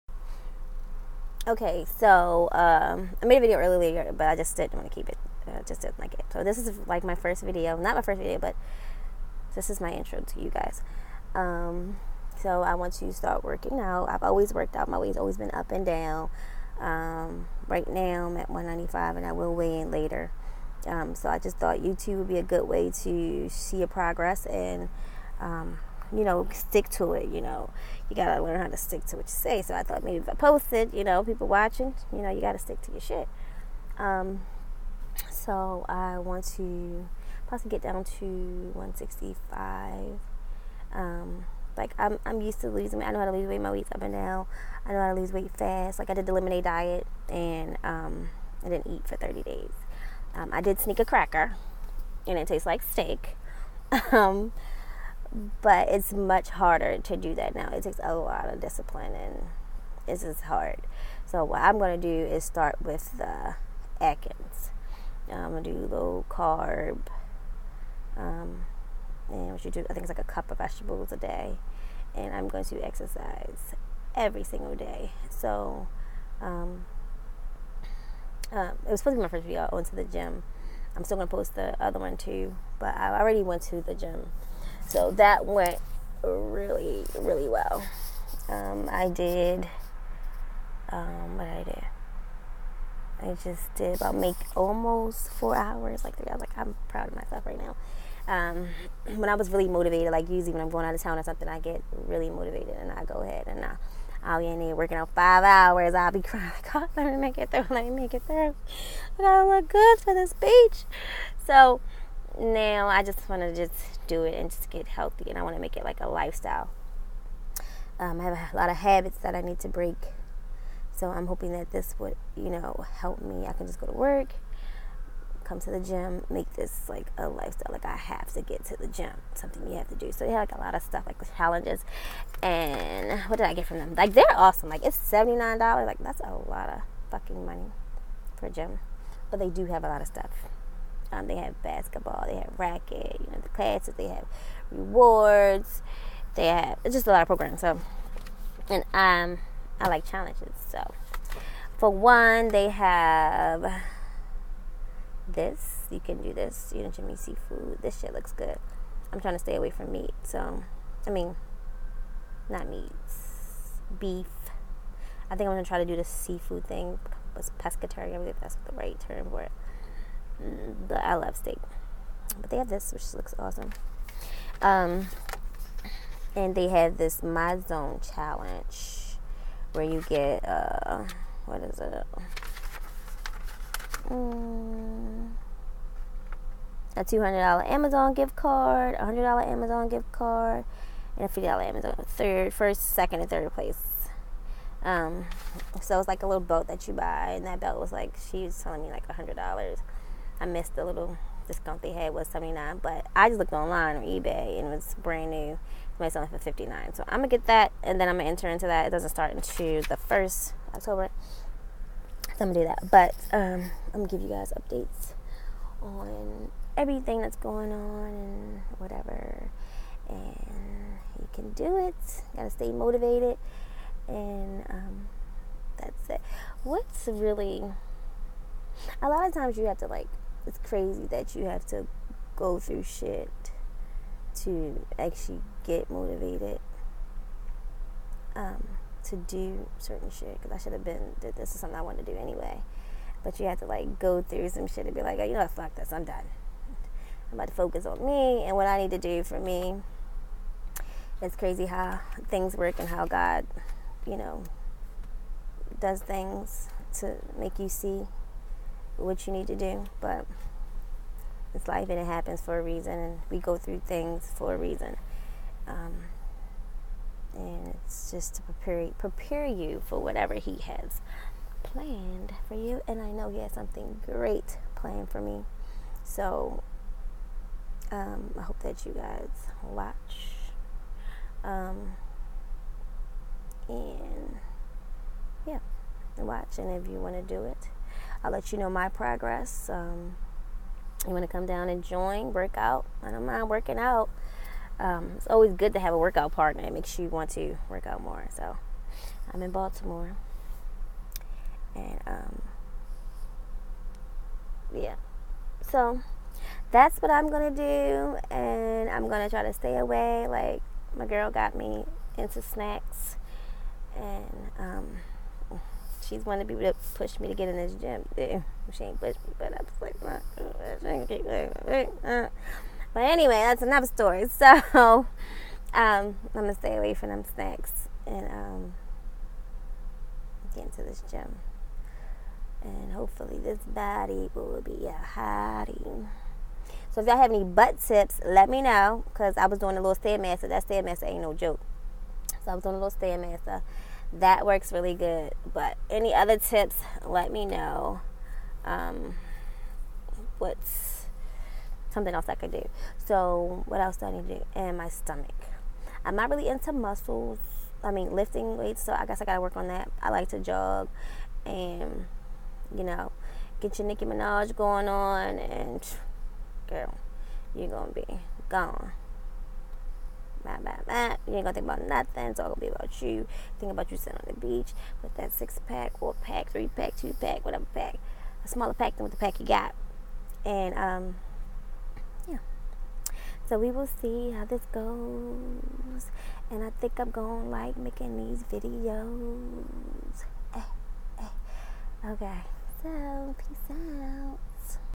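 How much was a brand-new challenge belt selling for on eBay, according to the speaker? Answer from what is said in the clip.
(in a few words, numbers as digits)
$59.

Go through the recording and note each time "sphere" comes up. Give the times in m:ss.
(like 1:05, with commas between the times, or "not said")
not said.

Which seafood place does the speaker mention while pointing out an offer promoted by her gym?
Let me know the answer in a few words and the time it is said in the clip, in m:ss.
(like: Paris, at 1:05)
Jimmy Seafood, at 2:36.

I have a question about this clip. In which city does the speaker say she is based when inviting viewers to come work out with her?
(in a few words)
Baltimore.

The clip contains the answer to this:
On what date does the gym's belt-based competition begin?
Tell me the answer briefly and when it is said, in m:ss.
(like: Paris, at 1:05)
October 1st, at 3:29.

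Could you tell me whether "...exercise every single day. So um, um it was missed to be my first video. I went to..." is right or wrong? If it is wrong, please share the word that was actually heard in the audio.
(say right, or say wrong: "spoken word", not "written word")
wrong: "supposed", not "missed".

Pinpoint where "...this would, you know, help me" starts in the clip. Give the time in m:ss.
2:01.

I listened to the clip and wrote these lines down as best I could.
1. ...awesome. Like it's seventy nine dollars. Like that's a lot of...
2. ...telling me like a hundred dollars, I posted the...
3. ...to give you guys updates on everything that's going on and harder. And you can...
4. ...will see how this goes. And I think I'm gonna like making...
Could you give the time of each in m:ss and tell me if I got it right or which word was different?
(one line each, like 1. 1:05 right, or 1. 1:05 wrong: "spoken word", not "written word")
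1. 2:14 right
2. 3:18 wrong: "missed", not "posted"
3. 3:34 wrong: "whatever", not "harder"
4. 6:23 right.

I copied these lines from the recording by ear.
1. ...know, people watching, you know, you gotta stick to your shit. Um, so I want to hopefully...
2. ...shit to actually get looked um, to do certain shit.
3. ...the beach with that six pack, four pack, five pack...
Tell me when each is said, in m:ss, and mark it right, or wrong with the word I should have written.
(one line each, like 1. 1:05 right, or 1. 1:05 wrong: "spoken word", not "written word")
1. 0:31 wrong: "possibly", not "hopefully"
2. 3:52 wrong: "motivated", not "looked"
3. 6:14 wrong: "three", not "five".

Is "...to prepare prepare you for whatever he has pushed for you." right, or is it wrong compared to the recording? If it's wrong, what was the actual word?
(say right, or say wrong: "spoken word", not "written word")
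wrong: "planned", not "pushed".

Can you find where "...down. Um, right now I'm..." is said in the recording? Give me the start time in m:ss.
0:15.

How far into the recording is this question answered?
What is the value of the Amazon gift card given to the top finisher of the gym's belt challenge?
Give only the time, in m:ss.
3:07.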